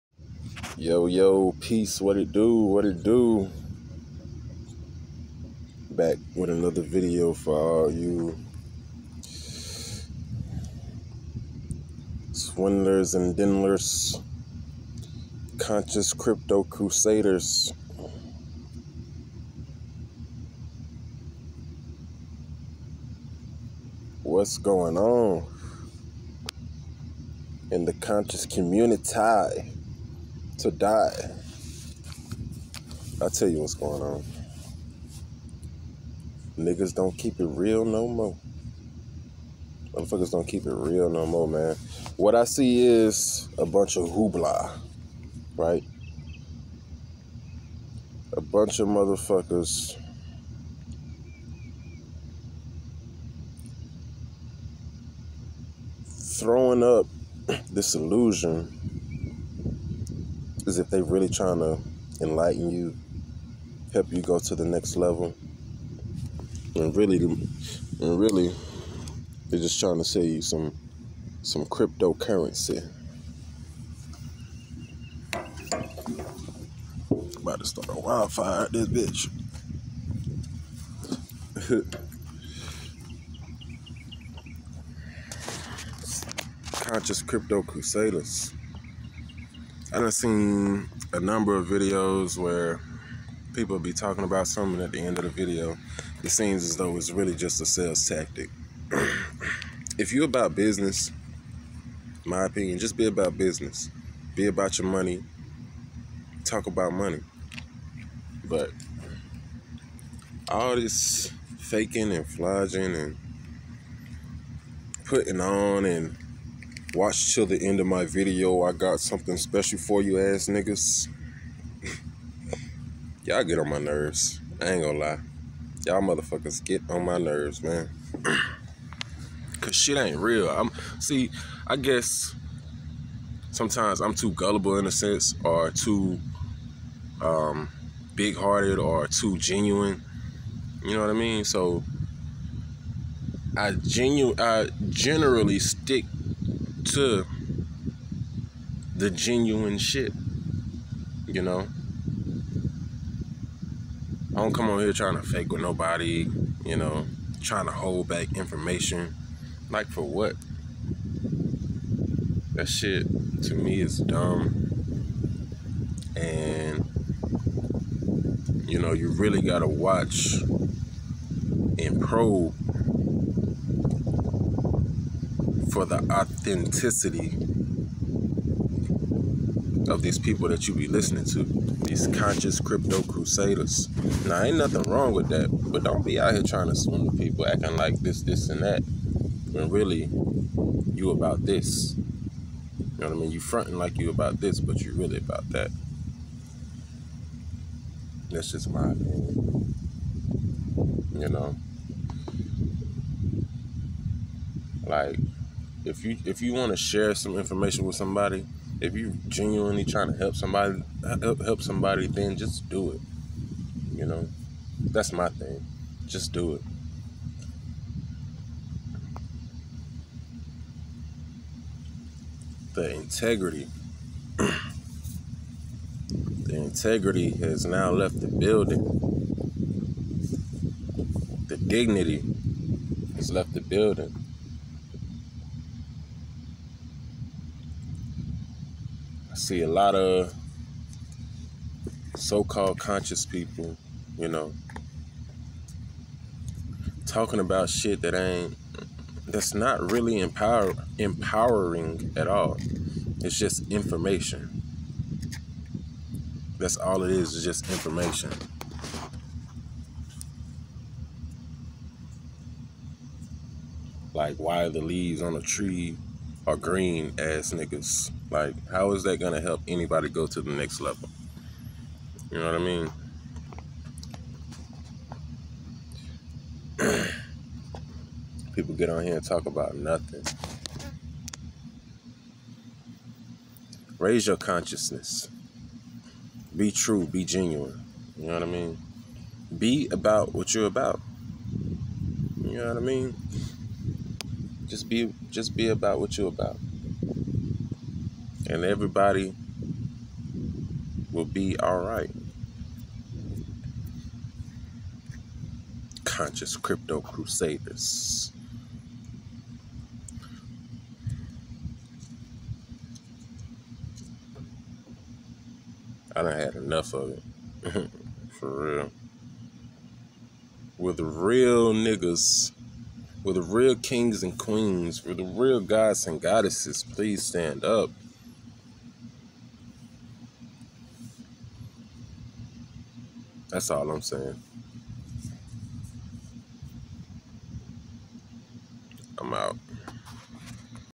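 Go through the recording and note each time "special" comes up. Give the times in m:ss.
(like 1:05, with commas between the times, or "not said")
1:59.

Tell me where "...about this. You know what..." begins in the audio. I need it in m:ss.
3:11.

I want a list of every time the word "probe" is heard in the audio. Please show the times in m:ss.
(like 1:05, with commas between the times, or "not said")
2:52.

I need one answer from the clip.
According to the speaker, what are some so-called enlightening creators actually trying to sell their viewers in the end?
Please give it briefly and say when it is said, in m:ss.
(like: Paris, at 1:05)
cryptocurrency, at 1:11.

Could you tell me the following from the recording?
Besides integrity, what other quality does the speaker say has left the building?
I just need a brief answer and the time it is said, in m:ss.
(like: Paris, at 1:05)
dignity, at 3:51.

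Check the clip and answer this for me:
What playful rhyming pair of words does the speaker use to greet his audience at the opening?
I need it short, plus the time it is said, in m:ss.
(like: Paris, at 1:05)
swindlers and dindlers, at 0:12.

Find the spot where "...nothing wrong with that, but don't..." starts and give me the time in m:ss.
3:04.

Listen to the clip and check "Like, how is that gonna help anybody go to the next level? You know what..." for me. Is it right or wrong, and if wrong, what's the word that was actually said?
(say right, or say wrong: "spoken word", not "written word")
right.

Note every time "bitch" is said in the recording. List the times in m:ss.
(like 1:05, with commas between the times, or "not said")
1:18.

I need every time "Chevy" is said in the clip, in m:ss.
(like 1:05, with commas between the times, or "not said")
not said.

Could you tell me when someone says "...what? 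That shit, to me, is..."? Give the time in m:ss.
2:40.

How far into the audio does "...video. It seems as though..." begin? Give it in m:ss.
1:35.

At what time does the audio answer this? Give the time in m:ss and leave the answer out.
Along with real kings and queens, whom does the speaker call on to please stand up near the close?
5:25.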